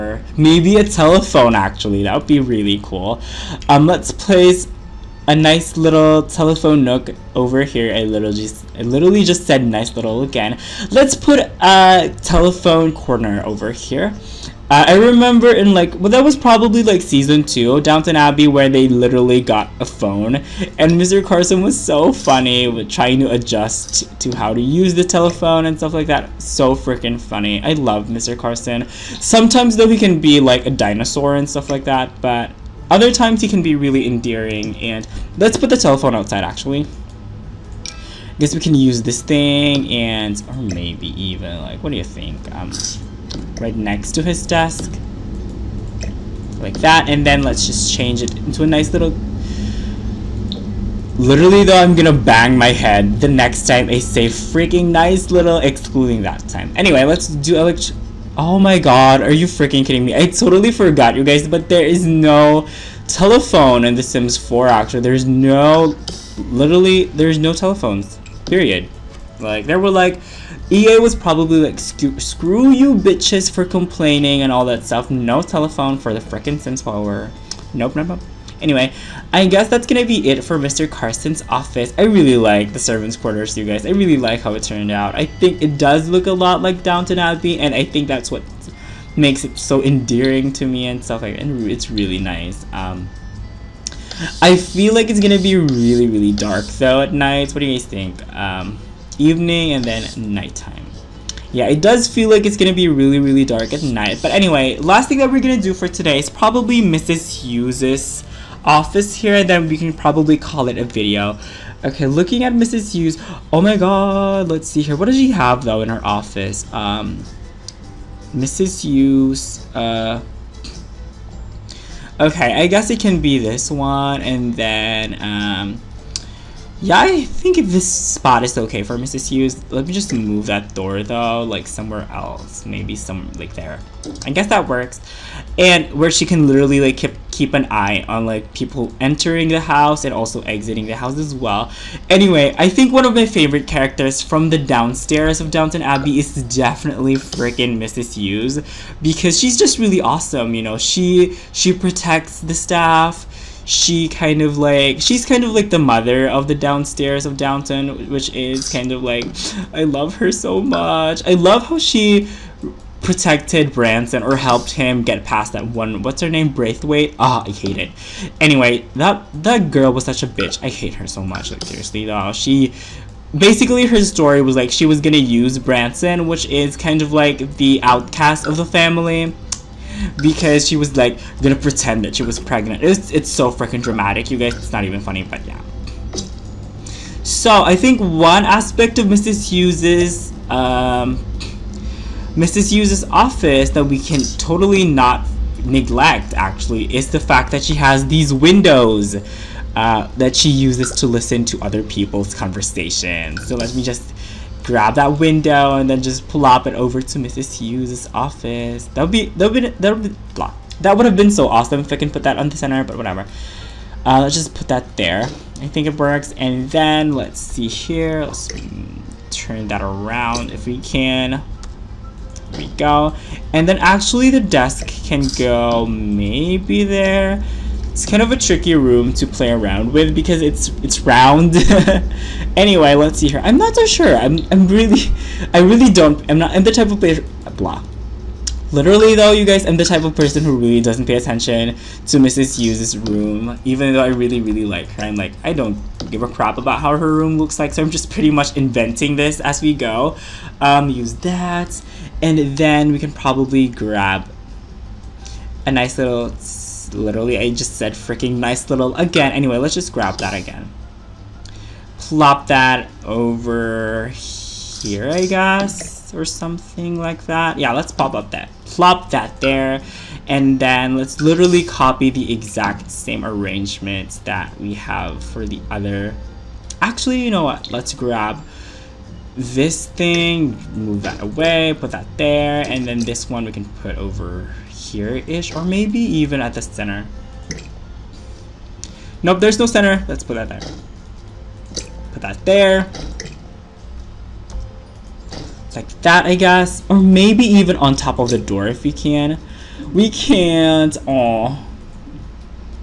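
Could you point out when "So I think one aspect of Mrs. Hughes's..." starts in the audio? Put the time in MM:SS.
03:07.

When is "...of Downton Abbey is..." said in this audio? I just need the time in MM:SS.
02:25.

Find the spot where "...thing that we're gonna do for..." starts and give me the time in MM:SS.
01:45.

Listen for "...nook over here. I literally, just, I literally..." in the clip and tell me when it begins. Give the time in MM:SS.
00:06.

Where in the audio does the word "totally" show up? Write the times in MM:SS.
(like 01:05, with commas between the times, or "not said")
01:00, 03:14.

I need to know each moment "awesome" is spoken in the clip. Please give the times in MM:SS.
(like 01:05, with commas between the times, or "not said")
02:30, 03:31.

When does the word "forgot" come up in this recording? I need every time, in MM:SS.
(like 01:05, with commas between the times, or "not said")
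01:00.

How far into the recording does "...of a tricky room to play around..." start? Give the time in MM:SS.
03:48.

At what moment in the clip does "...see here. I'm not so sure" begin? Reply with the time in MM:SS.
03:53.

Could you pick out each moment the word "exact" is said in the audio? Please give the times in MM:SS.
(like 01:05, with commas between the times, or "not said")
04:32.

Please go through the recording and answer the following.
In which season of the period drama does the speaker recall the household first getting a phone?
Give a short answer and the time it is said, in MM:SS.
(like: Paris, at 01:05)
season two, at 00:17.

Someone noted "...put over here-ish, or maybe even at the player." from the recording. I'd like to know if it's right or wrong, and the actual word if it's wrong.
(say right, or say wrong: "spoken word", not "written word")
wrong: "center", not "player".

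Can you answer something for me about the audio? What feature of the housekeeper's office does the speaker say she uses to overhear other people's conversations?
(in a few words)
windows.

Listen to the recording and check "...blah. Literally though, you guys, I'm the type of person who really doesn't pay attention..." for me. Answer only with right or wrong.
right.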